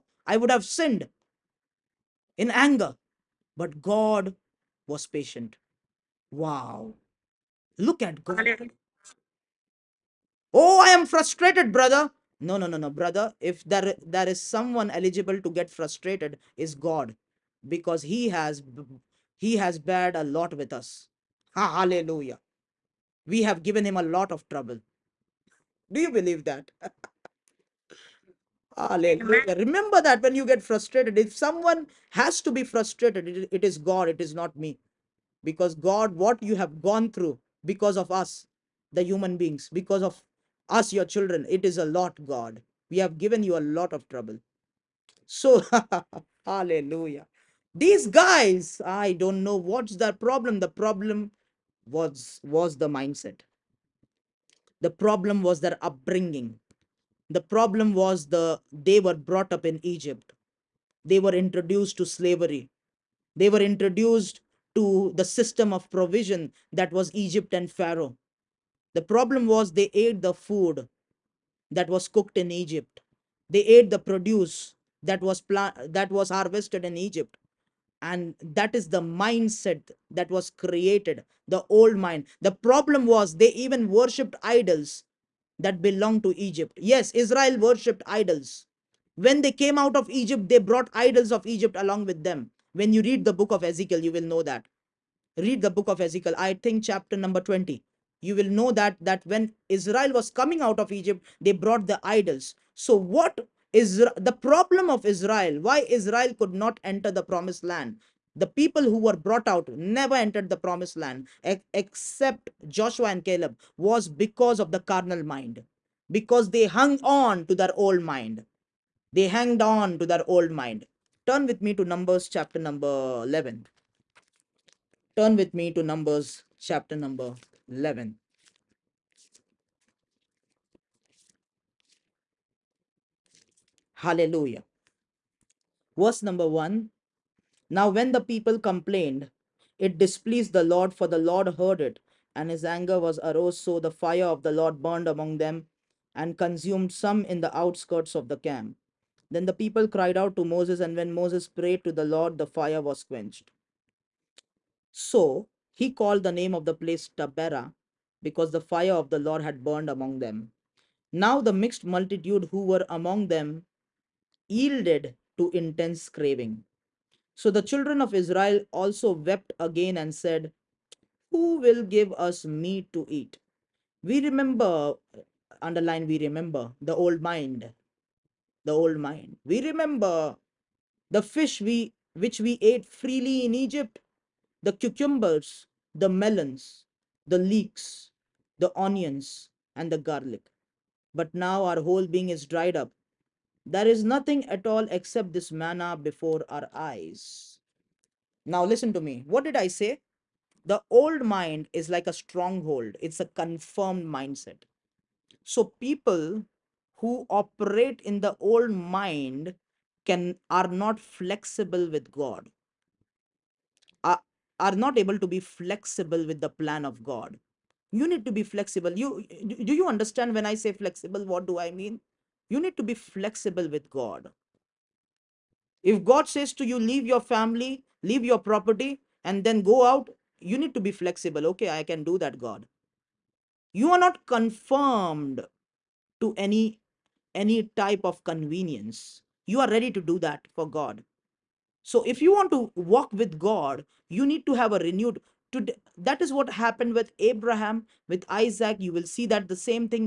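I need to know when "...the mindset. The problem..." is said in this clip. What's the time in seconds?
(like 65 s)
52 s.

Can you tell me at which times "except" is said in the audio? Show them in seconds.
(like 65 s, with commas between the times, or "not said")
111 s, 194 s.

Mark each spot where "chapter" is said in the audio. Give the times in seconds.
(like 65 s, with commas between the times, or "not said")
96 s, 122 s, 126 s.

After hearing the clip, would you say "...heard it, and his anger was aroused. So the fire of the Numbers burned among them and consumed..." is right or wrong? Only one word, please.
wrong.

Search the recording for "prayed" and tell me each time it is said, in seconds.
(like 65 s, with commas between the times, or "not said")
151 s.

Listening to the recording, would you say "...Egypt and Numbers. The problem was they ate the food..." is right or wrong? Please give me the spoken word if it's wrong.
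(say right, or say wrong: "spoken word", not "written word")
wrong: "Pharaoh", not "Numbers".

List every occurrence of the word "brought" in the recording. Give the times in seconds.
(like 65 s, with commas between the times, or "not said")
59 s, 90 s, 101 s, 109 s.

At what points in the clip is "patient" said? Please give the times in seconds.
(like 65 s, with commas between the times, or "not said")
5 s.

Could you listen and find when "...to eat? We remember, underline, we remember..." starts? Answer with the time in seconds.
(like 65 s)
172 s.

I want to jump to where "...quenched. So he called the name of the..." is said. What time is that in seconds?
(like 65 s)
153 s.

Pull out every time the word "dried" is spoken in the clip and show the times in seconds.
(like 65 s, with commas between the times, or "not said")
192 s.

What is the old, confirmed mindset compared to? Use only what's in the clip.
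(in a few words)
A stronghold.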